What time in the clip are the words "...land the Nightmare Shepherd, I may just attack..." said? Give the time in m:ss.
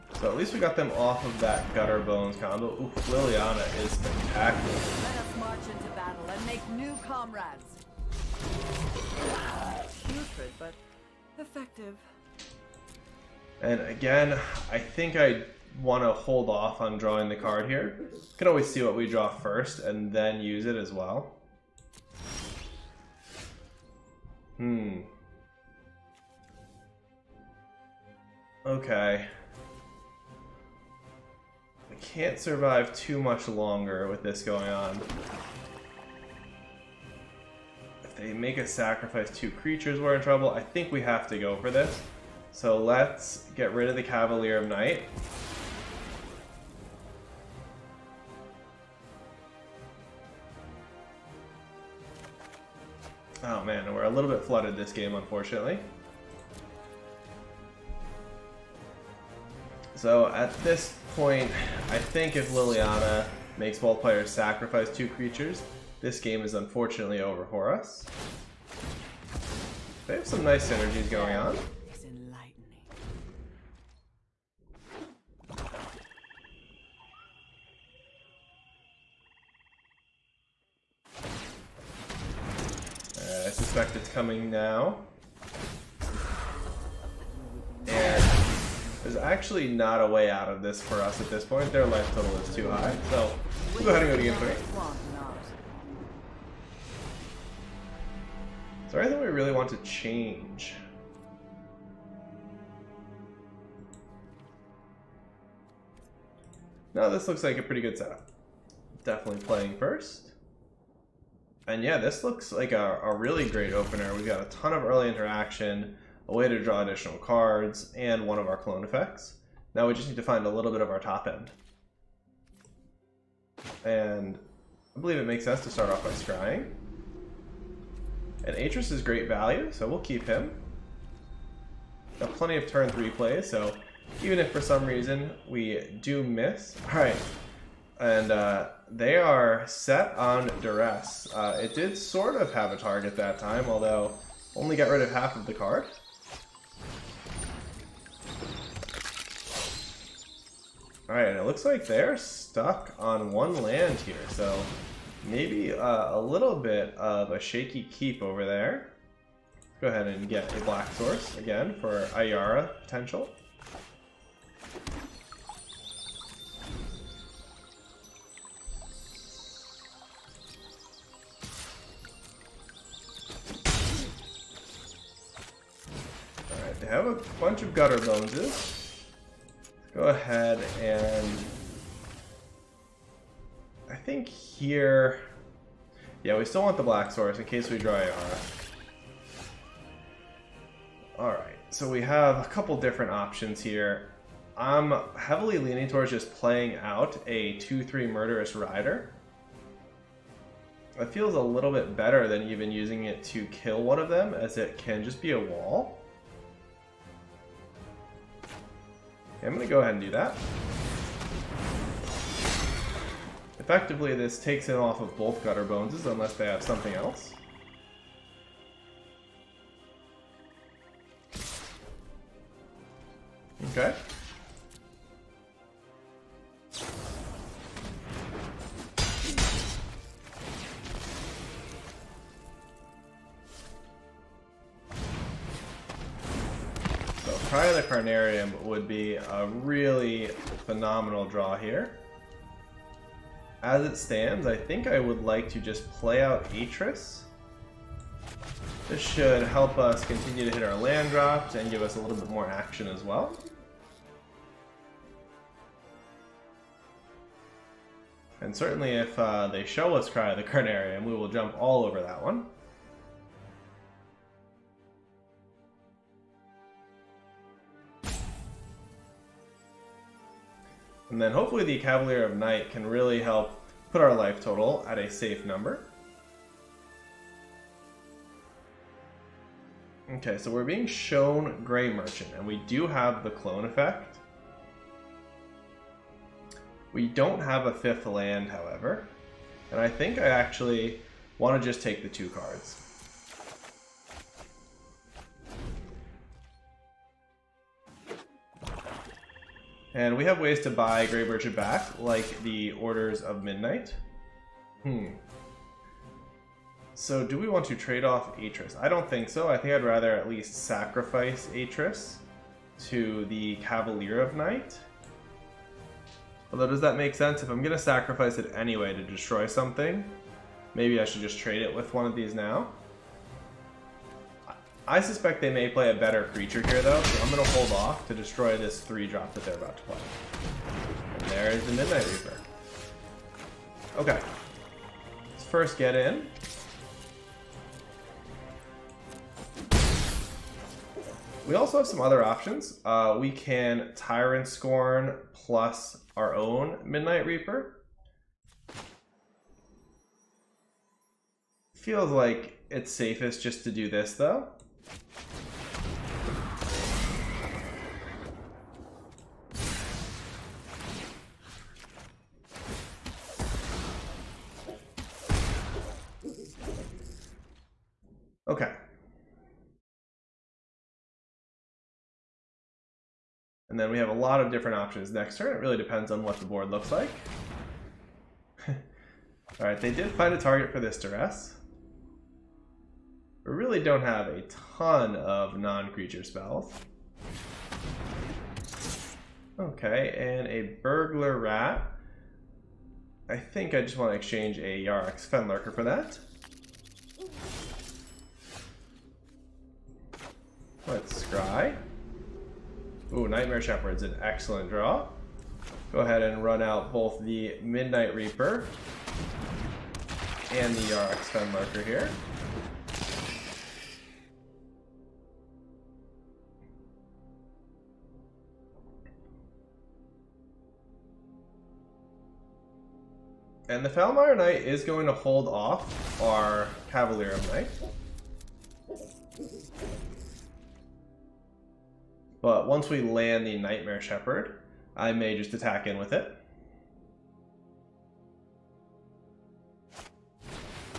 7:13.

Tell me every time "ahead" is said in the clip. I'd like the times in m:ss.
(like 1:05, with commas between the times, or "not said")
1:33, 2:39, 3:00, 3:29, 6:45.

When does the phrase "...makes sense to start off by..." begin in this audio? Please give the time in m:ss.
2:05.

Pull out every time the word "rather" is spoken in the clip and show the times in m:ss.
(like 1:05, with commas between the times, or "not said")
5:09.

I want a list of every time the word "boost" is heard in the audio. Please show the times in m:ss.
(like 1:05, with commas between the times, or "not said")
not said.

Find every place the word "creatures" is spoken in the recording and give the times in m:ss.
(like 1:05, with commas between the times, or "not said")
0:39, 1:05, 5:26, 6:25.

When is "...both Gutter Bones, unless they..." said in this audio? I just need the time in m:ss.
3:35.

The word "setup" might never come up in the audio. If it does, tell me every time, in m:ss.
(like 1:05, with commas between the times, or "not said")
1:47.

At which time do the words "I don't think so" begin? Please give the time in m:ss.
5:08.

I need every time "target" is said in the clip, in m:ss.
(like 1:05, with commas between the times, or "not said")
2:22, 6:20.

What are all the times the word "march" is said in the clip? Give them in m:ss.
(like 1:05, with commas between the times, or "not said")
0:05.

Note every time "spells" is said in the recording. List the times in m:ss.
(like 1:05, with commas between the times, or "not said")
6:26.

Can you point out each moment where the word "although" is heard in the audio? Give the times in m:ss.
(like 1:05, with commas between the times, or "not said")
2:23, 5:16.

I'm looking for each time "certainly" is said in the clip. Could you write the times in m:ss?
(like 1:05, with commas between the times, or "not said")
4:18.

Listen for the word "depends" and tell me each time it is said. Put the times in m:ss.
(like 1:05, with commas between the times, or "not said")
6:15.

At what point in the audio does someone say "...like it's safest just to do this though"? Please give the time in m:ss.
5:52.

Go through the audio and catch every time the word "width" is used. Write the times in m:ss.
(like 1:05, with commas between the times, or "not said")
not said.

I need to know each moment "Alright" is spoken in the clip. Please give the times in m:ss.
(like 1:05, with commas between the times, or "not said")
2:16, 2:31, 3:11, 6:19.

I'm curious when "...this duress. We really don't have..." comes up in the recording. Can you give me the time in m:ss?
6:20.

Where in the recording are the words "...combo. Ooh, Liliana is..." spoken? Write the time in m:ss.
0:02.